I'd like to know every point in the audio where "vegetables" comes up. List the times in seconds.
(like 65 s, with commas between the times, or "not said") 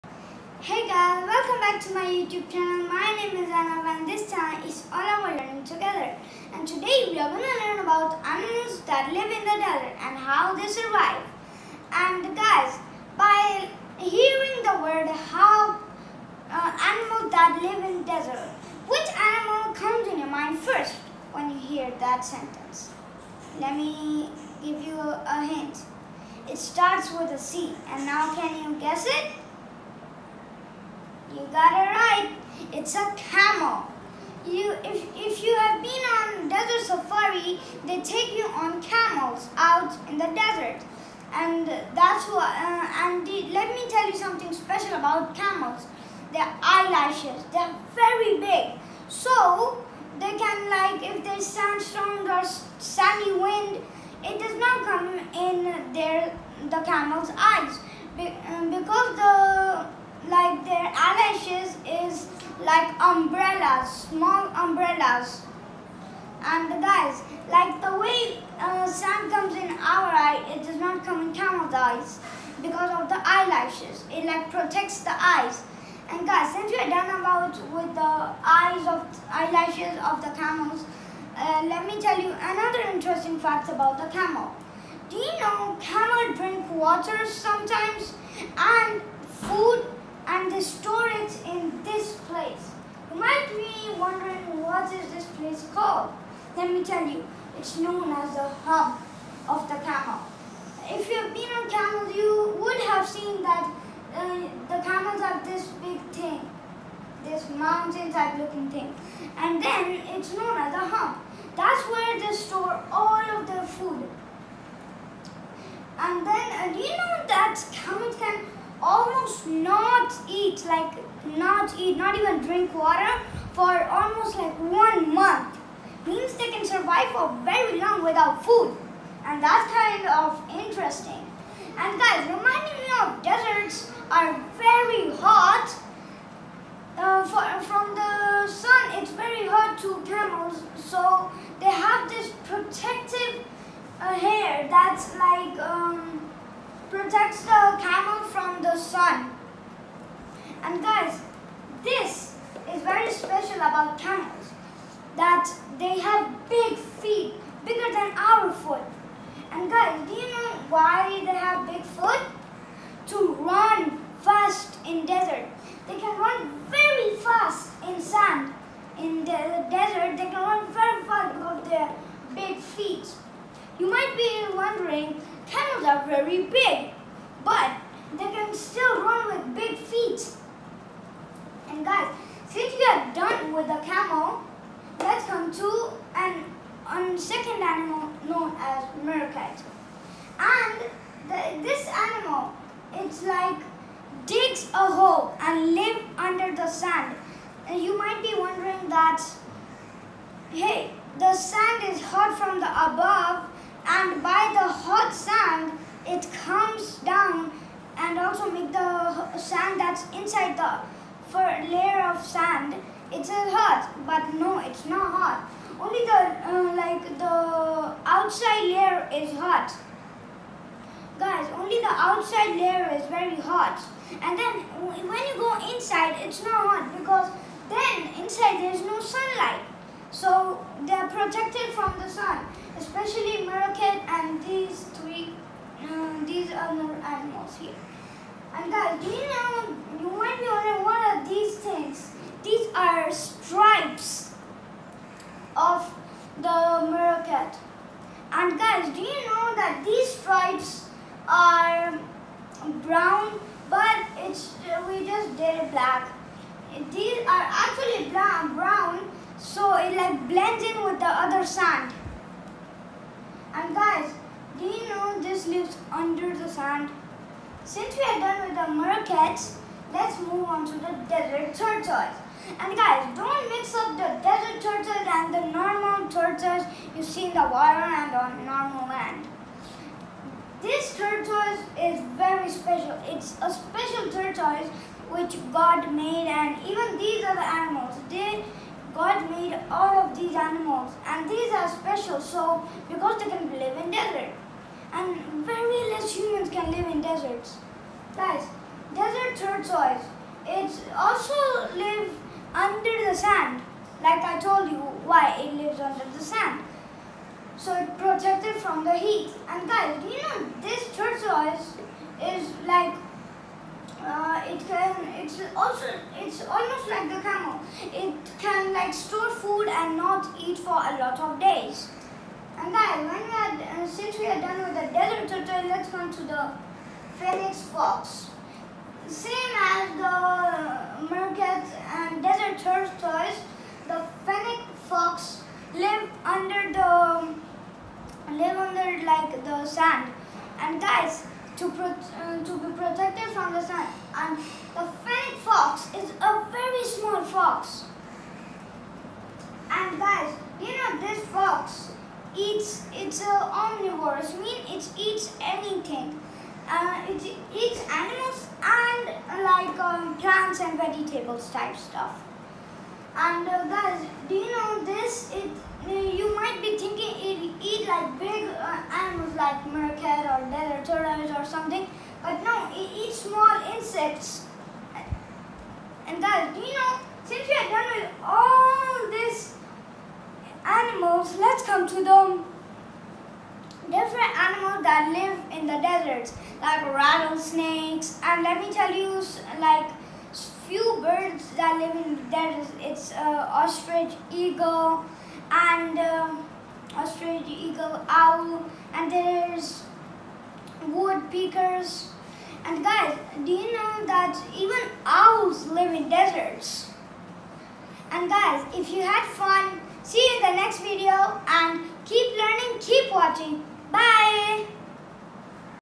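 360 s.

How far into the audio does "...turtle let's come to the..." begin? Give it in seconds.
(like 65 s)
325 s.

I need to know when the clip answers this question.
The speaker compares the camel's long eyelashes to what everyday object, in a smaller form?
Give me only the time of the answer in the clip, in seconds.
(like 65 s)
63 s.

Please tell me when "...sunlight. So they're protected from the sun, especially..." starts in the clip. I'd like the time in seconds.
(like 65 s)
228 s.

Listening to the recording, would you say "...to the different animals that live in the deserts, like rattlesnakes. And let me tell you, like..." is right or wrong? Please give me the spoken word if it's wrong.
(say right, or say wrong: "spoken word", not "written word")
right.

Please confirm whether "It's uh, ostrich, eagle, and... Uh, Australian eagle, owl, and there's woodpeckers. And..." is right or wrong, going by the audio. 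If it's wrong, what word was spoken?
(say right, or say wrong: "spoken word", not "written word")
right.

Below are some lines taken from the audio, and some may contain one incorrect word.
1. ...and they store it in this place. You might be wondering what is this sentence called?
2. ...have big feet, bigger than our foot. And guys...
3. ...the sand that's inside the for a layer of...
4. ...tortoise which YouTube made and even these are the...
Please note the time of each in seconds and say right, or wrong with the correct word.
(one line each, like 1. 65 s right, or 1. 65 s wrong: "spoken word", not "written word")
1. 90 s wrong: "place", not "sentence"
2. 155 s right
3. 208 s right
4. 284 s wrong: "God", not "YouTube".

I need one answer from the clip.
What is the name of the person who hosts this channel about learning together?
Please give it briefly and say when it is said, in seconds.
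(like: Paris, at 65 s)
Anav, at 3 s.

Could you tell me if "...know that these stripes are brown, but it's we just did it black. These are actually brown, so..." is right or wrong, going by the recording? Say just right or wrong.
right.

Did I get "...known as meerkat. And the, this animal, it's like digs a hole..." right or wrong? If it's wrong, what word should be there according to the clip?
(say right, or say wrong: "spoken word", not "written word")
right.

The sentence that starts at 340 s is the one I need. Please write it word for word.
And guys, to pro uh, to be protected from the sun.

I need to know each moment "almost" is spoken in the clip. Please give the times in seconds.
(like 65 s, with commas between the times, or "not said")
118 s, 123 s, 316 s.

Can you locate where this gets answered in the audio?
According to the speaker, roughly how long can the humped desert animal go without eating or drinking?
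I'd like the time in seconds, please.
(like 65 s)
124 s.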